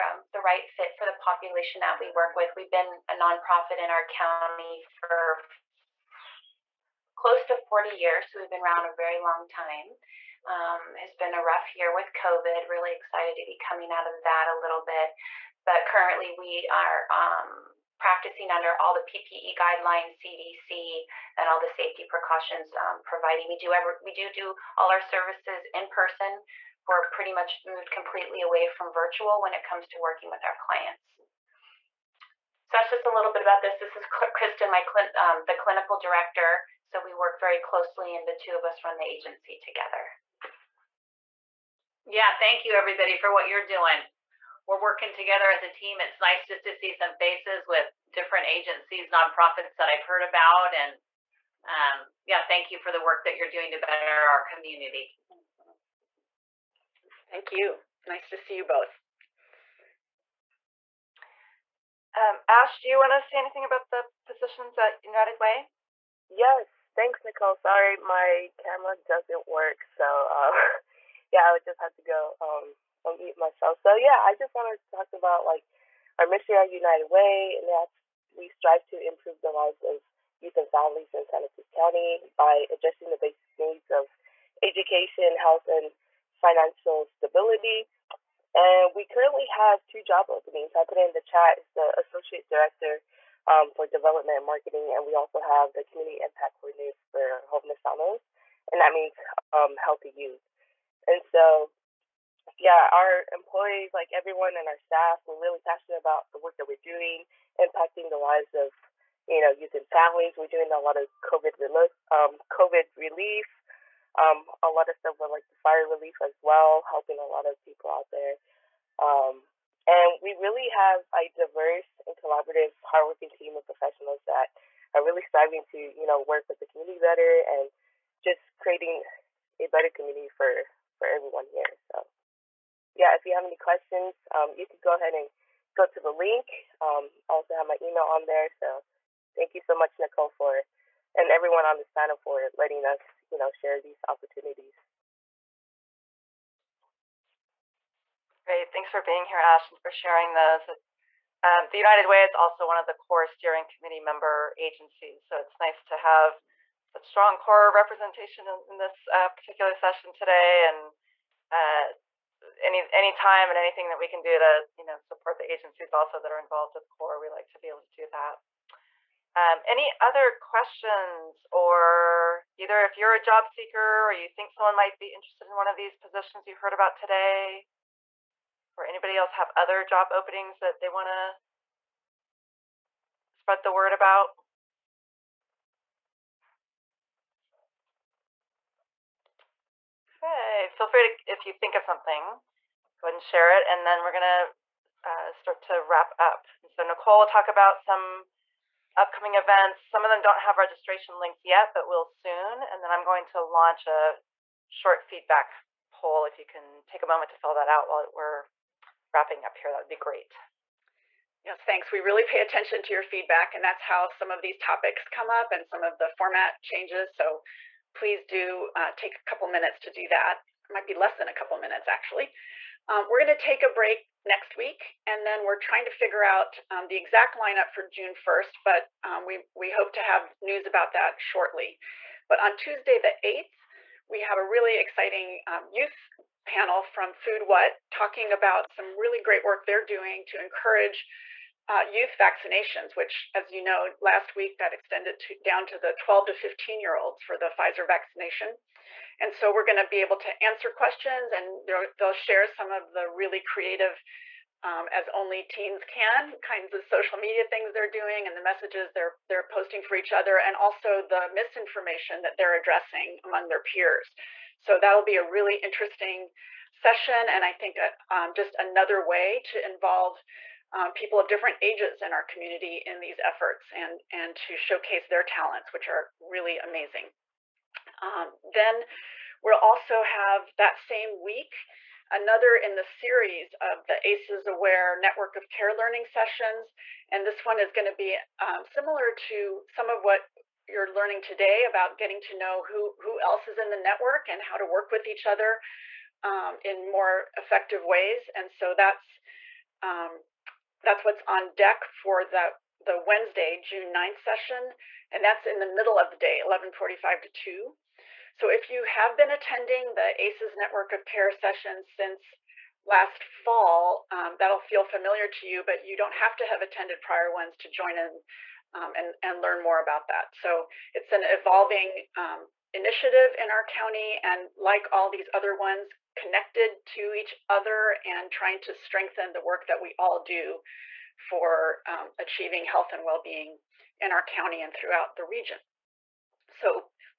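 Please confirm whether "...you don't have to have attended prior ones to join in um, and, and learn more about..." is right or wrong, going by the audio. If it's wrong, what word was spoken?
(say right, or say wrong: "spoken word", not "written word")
right.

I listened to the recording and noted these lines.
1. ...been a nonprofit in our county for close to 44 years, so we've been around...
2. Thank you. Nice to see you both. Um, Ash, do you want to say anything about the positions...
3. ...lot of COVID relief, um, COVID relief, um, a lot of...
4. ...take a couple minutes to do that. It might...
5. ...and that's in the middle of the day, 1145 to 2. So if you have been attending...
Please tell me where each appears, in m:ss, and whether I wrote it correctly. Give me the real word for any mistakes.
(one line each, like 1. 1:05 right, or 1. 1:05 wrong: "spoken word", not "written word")
1. 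0:02 wrong: "40", not "44"
2. 0:57 right
3. 1:50 right
4. 3:38 right
5. 5:05 right.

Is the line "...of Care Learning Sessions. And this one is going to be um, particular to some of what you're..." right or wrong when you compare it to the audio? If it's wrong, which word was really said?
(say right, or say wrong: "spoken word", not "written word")
wrong: "similar", not "particular".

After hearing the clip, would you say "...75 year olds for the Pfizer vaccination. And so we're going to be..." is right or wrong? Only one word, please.
wrong.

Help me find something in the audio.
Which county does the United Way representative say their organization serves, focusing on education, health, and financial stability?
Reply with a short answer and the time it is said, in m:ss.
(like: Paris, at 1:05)
Santa Cruz County, at 1:21.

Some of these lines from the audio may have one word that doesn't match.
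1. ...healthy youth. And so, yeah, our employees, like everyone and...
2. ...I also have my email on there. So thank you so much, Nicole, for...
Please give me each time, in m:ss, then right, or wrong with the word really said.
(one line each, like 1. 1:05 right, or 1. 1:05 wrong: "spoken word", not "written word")
1. 1:39 right
2. 2:17 right.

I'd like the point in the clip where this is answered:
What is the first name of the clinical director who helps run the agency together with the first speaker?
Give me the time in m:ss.
0:34.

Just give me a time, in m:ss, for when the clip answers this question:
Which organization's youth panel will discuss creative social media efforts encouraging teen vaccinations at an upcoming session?
3:57.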